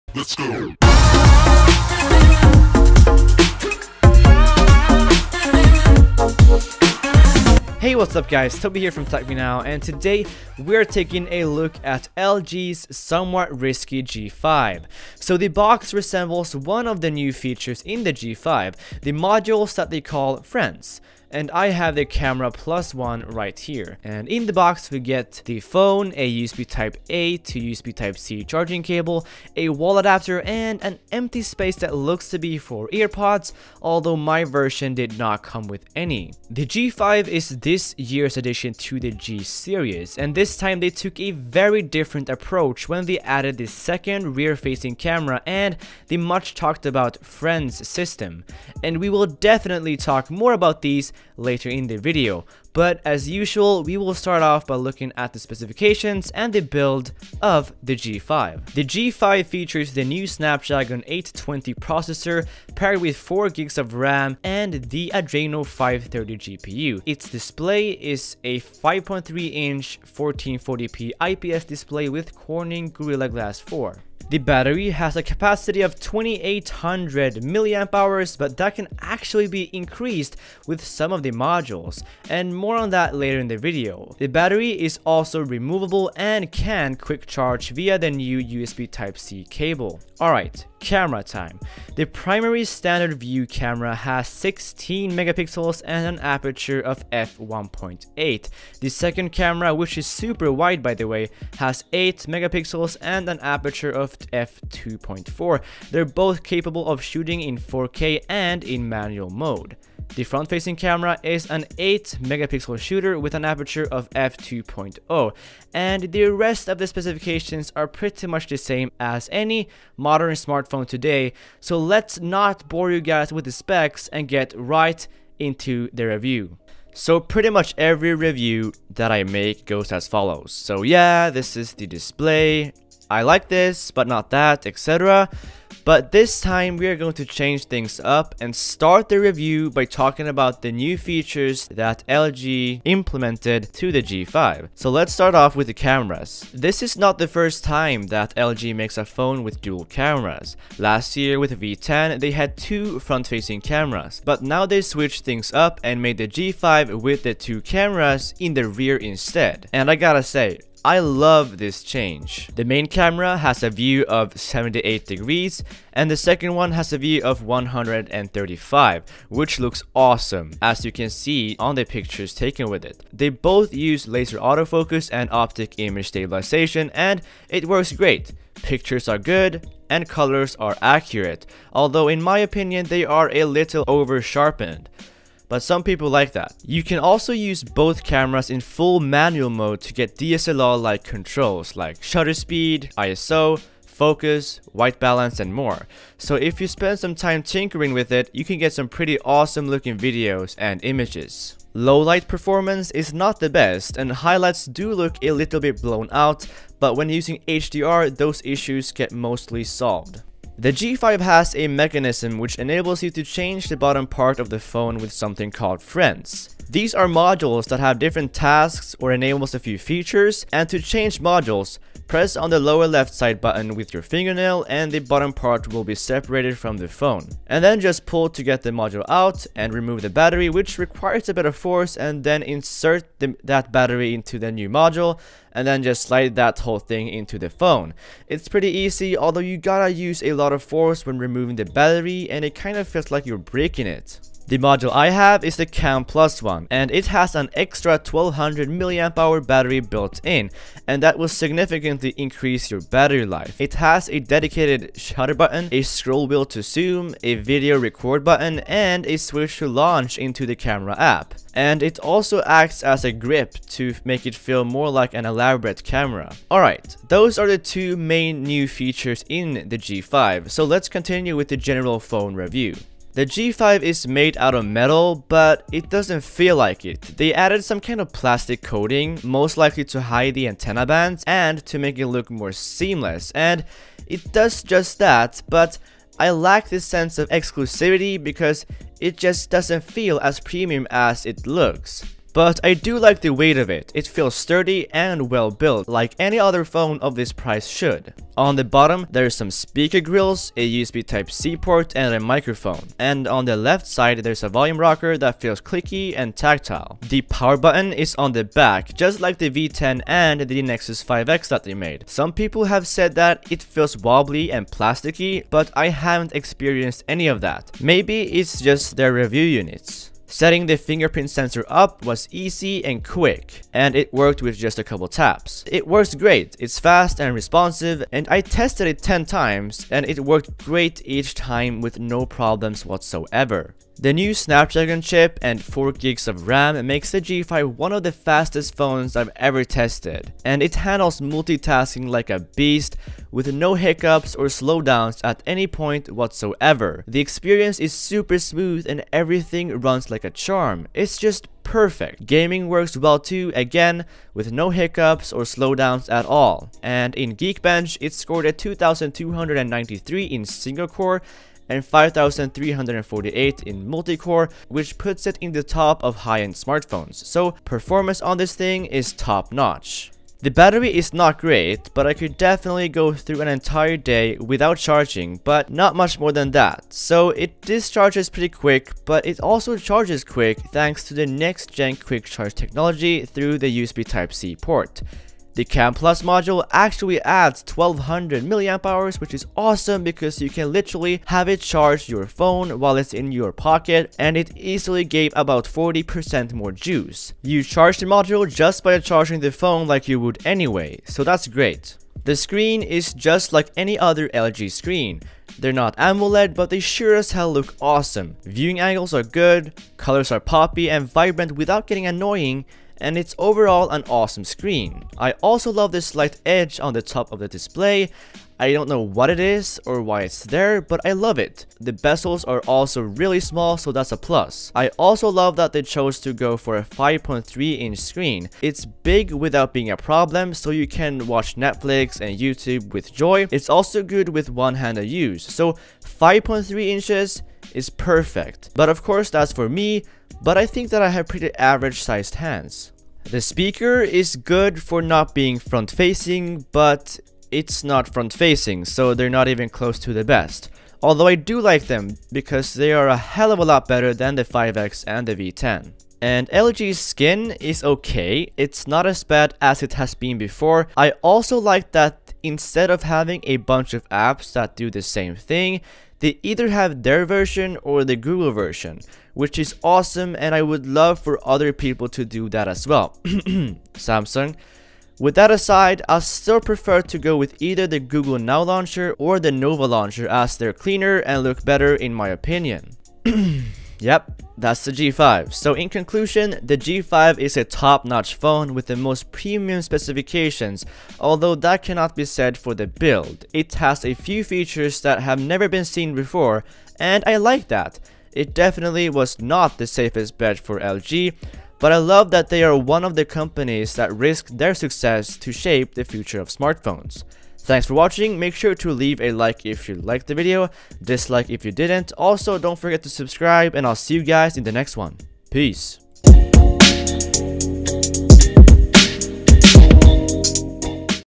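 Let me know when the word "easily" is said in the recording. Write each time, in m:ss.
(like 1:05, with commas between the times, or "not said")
6:34.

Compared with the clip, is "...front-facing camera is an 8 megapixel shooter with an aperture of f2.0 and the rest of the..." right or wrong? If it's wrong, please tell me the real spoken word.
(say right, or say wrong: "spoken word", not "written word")
right.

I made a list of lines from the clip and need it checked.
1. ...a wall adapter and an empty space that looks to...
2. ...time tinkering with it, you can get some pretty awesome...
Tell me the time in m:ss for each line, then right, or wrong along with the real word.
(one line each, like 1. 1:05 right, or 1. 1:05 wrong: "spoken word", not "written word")
1. 0:29 right
2. 3:17 right.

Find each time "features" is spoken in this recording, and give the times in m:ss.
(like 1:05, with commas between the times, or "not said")
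0:17, 0:59, 2:20, 3:39, 4:28, 8:14.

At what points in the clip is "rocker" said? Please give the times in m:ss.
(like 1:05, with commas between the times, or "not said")
5:04.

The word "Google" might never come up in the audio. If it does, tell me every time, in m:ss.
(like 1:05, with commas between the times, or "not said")
7:48, 7:57.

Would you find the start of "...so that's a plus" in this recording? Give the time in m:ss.
7:03.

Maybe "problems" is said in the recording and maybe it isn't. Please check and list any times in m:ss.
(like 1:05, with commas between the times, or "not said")
5:32, 7:09.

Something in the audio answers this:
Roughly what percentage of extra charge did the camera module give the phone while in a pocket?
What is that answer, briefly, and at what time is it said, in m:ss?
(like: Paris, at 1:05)
40%, at 6:35.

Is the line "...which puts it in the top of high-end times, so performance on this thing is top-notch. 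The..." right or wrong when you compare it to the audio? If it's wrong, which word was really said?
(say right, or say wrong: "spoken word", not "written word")
wrong: "smartphones", not "times".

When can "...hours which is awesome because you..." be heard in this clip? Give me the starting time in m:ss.
6:28.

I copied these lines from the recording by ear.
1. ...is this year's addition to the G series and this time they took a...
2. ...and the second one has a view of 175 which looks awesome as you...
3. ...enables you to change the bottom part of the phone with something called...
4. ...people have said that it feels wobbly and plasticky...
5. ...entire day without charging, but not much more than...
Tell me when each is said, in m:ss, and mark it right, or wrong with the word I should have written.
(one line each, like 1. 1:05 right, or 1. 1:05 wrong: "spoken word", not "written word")
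1. 0:37 right
2. 2:45 wrong: "135", not "175"
3. 3:32 right
4. 5:12 right
5. 6:13 right.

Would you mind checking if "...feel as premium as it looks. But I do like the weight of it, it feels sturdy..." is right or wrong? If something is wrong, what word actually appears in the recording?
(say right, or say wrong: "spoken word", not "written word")
right.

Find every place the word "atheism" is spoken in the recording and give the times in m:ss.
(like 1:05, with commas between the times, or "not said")
not said.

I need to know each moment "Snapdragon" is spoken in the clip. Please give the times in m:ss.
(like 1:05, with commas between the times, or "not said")
1:00, 5:34.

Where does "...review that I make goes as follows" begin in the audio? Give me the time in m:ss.
2:08.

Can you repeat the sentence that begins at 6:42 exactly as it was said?
The screen is just like any other LG screen.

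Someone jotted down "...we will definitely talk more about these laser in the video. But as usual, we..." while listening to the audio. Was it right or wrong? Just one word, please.
wrong.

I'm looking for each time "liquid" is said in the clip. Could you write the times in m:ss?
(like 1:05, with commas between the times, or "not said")
not said.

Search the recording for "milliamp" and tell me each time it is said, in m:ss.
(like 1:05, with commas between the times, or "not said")
1:17, 6:28.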